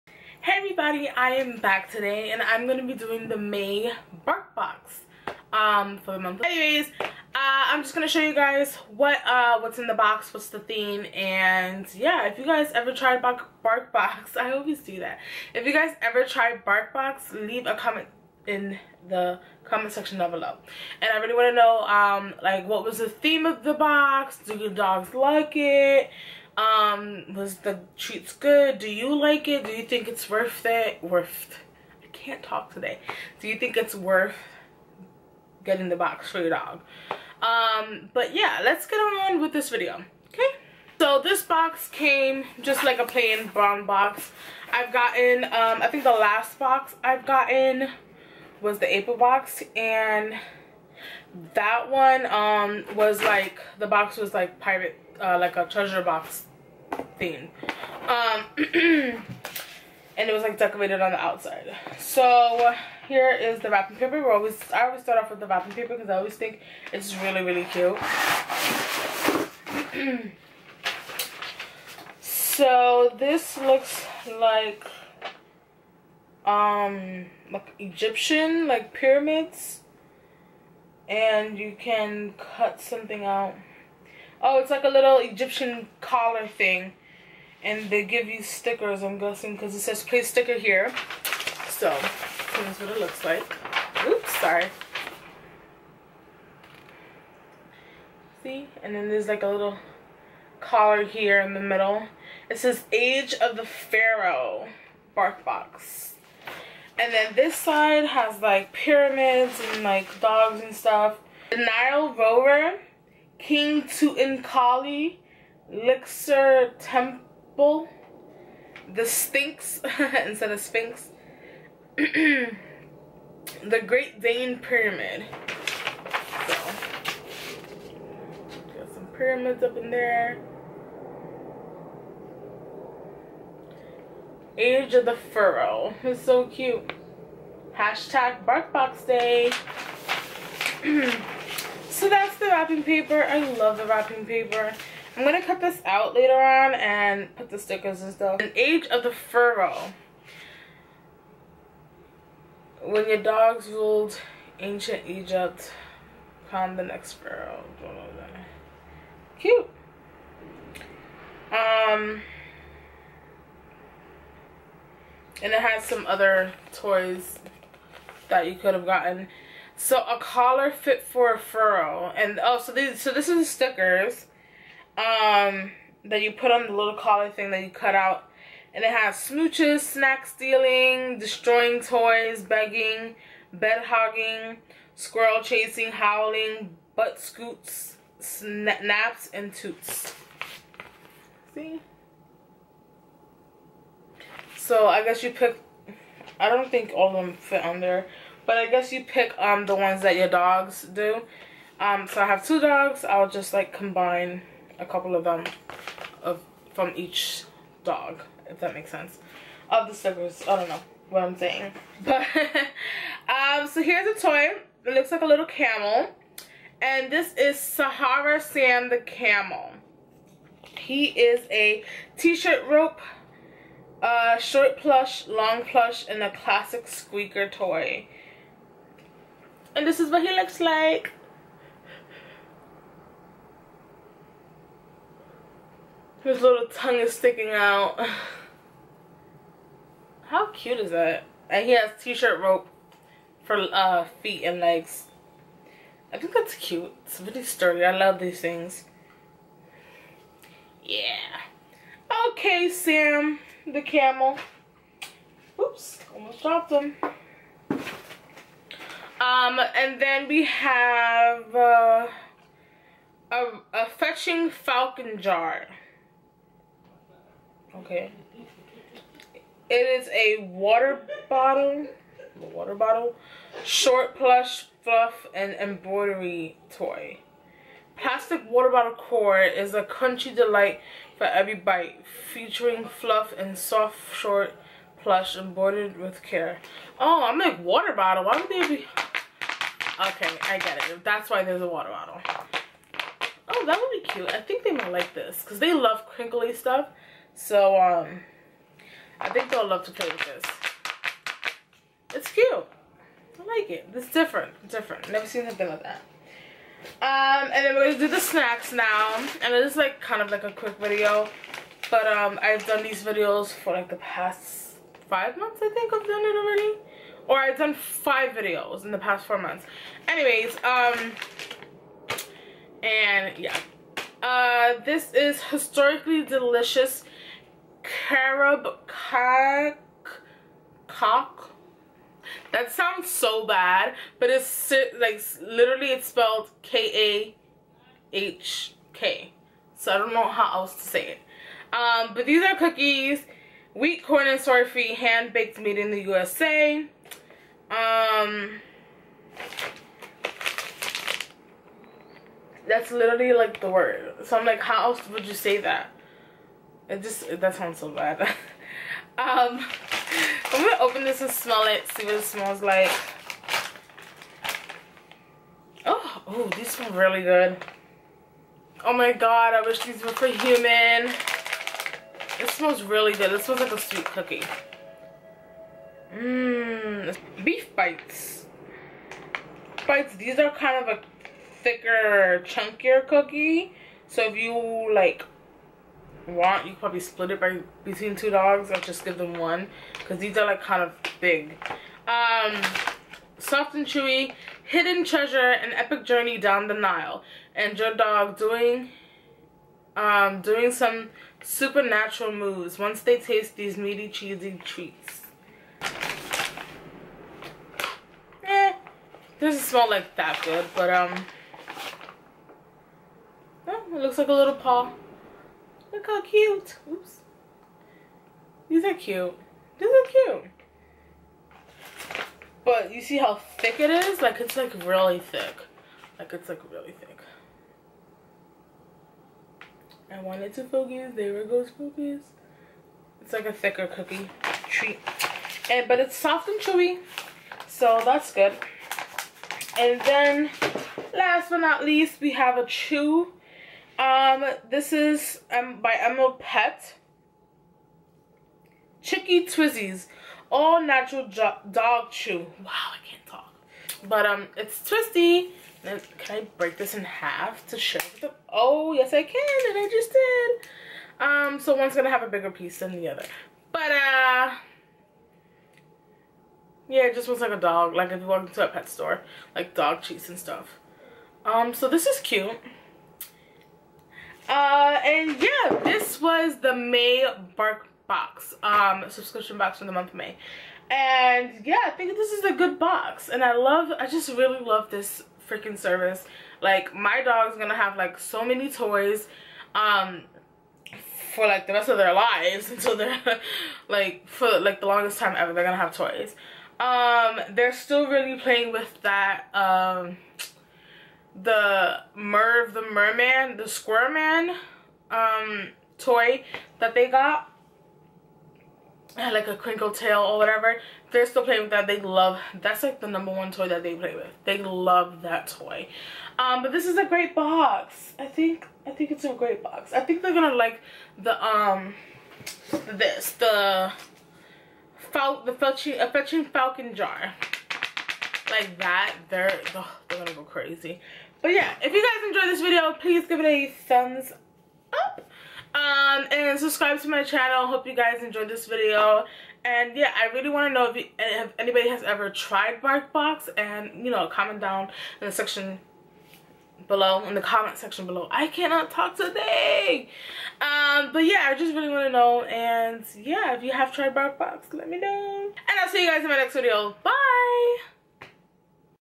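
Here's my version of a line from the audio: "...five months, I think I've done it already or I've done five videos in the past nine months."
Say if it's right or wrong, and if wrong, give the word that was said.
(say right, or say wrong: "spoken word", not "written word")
wrong: "four", not "nine".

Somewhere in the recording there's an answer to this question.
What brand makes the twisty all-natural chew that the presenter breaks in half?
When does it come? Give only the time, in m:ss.
7:25.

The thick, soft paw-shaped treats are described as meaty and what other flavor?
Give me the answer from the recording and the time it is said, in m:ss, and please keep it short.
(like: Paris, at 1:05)
Cheesy, at 6:44.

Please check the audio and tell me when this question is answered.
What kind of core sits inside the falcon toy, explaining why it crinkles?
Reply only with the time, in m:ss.
4:37.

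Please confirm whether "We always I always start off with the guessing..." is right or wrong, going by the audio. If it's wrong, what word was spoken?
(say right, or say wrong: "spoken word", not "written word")
wrong: "wrapping", not "guessing".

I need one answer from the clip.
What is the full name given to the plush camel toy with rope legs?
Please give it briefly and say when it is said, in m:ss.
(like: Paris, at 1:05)
Sahara Sam, at 3:37.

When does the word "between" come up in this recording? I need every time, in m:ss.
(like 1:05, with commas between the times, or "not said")
6:27.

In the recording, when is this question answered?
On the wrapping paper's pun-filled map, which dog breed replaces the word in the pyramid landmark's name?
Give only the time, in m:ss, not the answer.
2:03.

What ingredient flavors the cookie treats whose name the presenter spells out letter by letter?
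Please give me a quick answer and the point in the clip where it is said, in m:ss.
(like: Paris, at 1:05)
Carob, at 5:28.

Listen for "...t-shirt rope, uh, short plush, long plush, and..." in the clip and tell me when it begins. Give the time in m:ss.
3:42.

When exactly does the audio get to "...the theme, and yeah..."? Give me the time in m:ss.
0:10.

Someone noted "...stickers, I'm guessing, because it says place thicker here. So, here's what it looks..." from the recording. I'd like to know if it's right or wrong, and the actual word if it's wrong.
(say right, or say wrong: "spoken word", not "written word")
wrong: "sticker", not "thicker".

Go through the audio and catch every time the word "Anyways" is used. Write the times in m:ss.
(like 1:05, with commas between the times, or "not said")
0:06, 5:20.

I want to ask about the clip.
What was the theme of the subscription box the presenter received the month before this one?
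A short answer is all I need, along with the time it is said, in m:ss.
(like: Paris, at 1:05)
Pirate, at 0:54.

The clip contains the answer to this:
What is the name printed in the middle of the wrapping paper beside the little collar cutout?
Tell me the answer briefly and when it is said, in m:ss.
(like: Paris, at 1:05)
Age of the Pharaoh, at 1:42.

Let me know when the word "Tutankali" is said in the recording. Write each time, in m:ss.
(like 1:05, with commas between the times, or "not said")
1:53.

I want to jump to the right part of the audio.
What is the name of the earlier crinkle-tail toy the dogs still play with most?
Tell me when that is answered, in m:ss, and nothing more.
8:22.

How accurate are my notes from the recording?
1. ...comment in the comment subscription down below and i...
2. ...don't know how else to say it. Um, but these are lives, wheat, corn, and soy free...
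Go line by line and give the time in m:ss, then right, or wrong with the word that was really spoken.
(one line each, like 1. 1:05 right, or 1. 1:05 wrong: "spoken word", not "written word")
1. 0:17 wrong: "section", not "subscription"
2. 5:39 wrong: "cookies", not "lives".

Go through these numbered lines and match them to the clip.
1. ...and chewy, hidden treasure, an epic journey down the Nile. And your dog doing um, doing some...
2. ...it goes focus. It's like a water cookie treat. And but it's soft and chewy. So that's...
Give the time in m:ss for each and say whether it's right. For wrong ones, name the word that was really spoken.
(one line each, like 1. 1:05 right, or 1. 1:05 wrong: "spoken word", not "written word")
1. 6:33 right
2. 7:11 wrong: "thicker", not "water".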